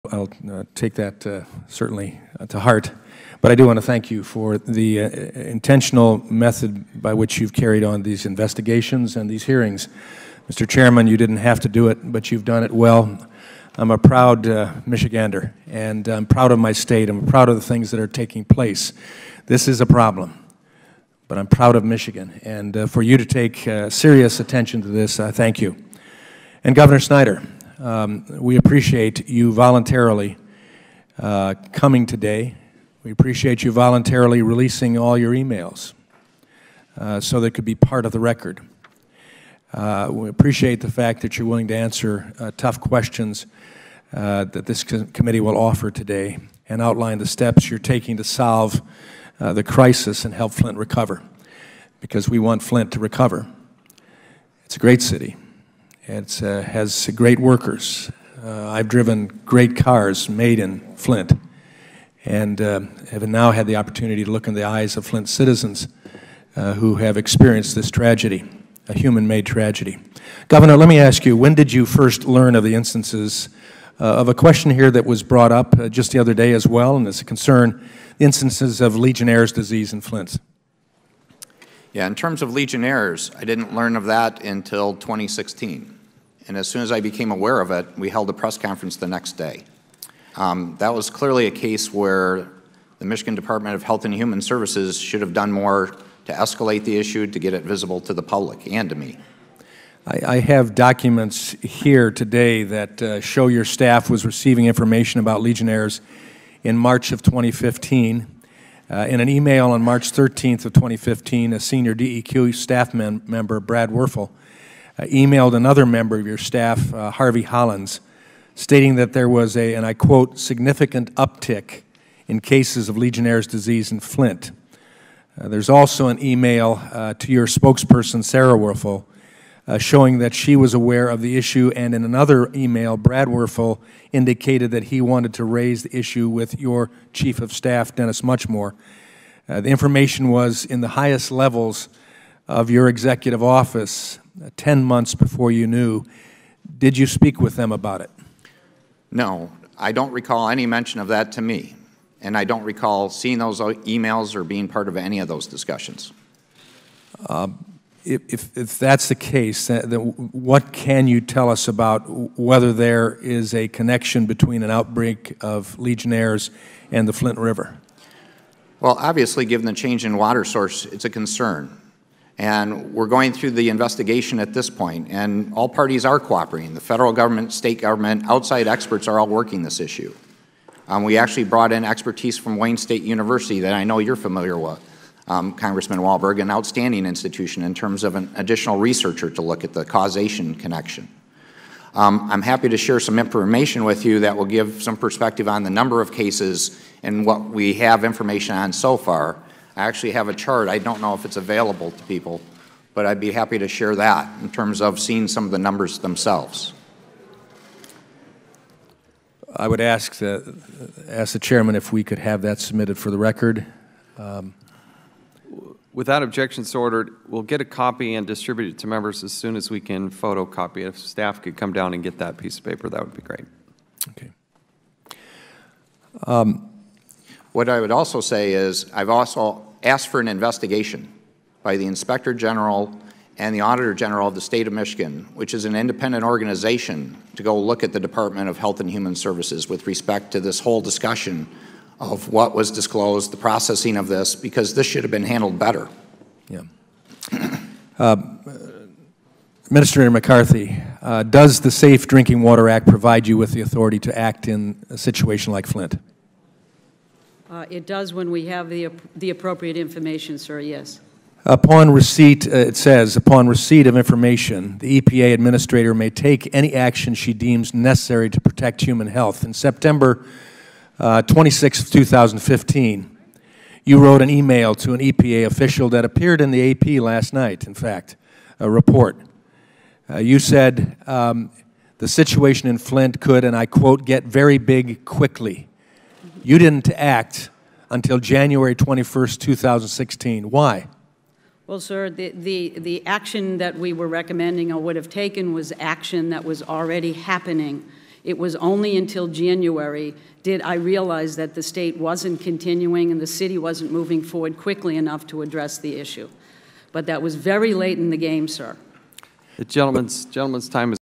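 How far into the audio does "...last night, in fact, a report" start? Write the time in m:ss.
4:37.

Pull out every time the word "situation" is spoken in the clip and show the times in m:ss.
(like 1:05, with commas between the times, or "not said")
4:14, 4:42.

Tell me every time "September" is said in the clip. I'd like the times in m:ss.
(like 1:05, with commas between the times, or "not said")
4:29.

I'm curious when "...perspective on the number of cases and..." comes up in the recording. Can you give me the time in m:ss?
3:14.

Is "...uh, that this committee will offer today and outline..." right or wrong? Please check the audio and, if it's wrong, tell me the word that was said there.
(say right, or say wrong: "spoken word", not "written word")
right.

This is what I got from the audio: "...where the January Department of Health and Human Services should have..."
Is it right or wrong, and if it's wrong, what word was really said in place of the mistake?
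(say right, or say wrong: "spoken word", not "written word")
wrong: "Michigan", not "January".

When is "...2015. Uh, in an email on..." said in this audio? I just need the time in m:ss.
1:47.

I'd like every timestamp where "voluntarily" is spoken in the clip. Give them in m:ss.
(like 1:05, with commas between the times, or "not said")
0:29, 0:33.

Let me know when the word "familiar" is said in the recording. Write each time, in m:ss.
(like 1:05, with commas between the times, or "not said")
3:04.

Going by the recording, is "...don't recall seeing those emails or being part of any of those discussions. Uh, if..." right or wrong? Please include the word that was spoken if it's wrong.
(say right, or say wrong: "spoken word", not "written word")
right.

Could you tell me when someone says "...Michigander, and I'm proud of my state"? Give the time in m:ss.
0:14.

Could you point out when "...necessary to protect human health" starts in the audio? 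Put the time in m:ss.
4:27.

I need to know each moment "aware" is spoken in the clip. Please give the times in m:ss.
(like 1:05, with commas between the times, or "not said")
1:27, 2:10.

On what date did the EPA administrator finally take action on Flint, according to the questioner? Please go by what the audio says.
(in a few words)
January 21st, 2016.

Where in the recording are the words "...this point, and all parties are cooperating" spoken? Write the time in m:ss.
2:54.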